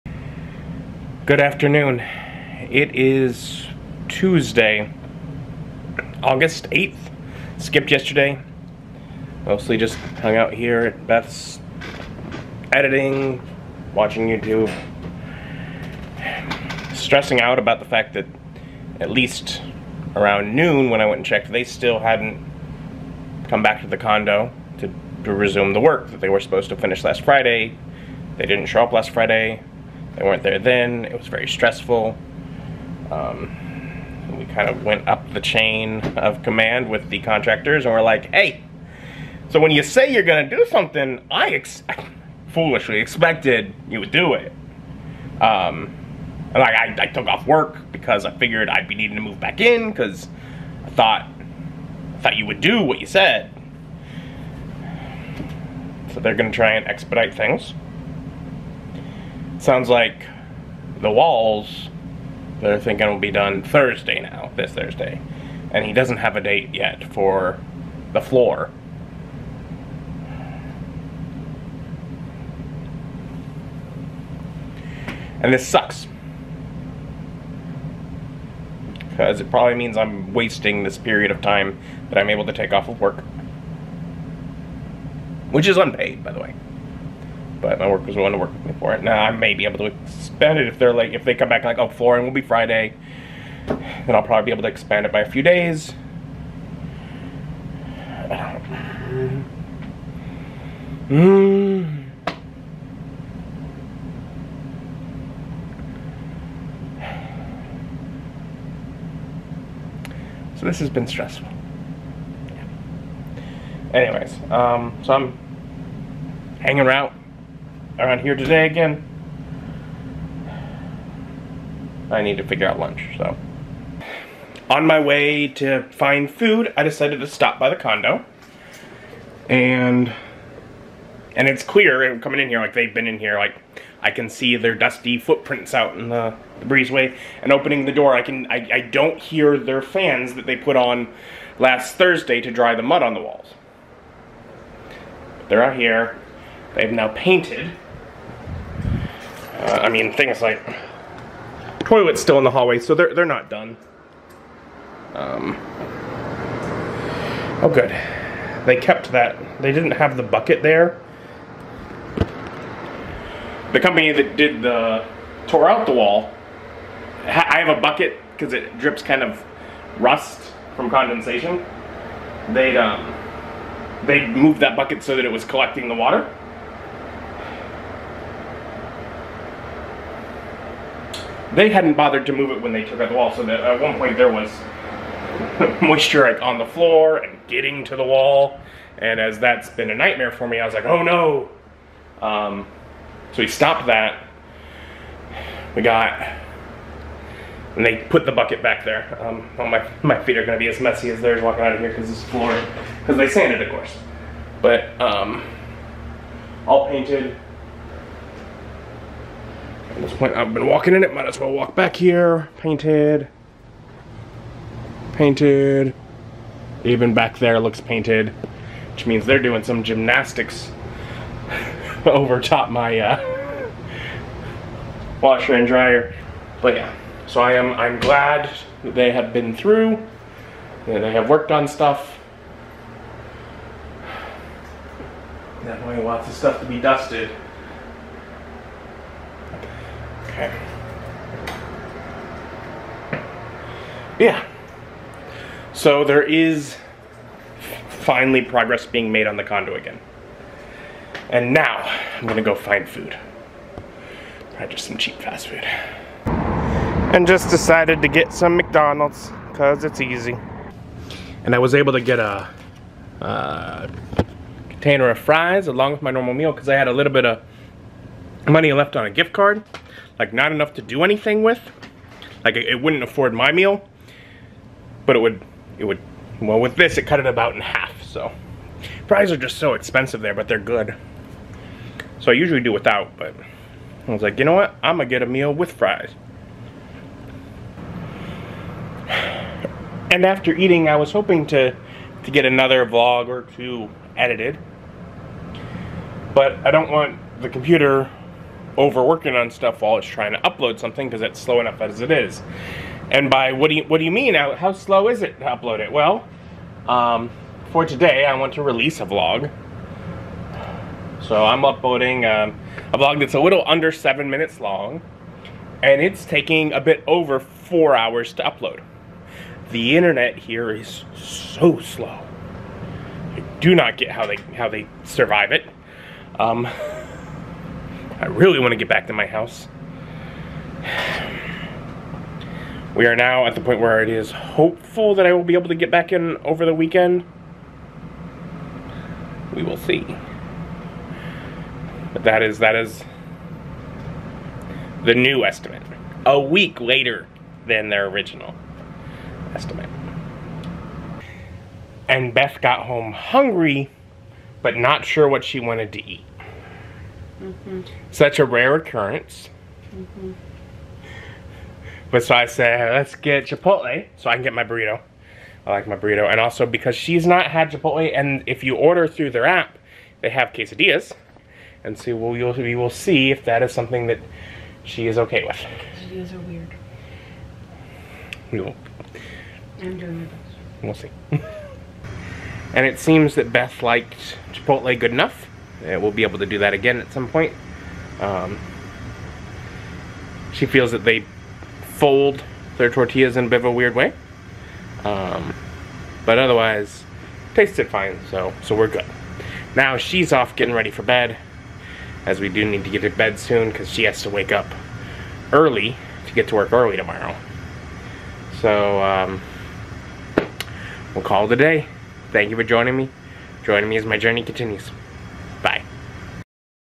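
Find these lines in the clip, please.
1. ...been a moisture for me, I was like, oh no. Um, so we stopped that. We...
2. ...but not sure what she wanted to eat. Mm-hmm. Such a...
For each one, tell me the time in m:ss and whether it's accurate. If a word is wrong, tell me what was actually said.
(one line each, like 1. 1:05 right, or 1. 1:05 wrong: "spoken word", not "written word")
1. 3:09 wrong: "nightmare", not "moisture"
2. 5:54 right.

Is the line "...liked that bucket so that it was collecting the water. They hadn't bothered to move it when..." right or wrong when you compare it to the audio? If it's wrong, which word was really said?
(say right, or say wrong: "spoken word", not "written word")
wrong: "moved", not "liked".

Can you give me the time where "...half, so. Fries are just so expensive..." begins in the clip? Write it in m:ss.
4:37.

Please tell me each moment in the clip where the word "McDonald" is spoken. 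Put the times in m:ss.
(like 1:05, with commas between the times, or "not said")
4:18.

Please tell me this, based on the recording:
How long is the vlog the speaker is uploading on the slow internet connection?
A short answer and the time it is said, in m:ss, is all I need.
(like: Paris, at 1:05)
under 7 minutes, at 5:13.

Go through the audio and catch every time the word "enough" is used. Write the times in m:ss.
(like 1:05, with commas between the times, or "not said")
4:30, 5:01, 6:25.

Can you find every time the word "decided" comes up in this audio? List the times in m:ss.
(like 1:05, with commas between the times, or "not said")
2:06, 4:17.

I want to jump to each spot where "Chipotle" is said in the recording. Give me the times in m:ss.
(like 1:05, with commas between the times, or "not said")
6:03, 6:07, 6:24.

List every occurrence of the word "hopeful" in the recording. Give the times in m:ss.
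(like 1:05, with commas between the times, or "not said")
5:34.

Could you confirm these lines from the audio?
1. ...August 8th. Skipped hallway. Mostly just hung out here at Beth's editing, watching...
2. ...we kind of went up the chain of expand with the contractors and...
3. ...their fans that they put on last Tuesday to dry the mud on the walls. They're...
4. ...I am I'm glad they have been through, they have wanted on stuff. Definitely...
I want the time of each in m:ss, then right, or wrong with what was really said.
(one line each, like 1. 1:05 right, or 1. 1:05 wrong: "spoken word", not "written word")
1. 0:06 wrong: "yesterday", not "hallway"
2. 0:34 wrong: "command", not "expand"
3. 2:19 wrong: "Thursday", not "Tuesday"
4. 3:47 wrong: "worked", not "wanted".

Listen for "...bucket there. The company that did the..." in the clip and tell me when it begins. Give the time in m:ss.
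2:40.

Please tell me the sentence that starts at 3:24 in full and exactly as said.
But um, all painted, this point, I've been walking in it, might as well walk back here.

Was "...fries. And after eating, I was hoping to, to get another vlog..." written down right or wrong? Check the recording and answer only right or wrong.
right.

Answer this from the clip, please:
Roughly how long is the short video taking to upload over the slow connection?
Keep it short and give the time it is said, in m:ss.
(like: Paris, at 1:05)
over 4 hours, at 5:16.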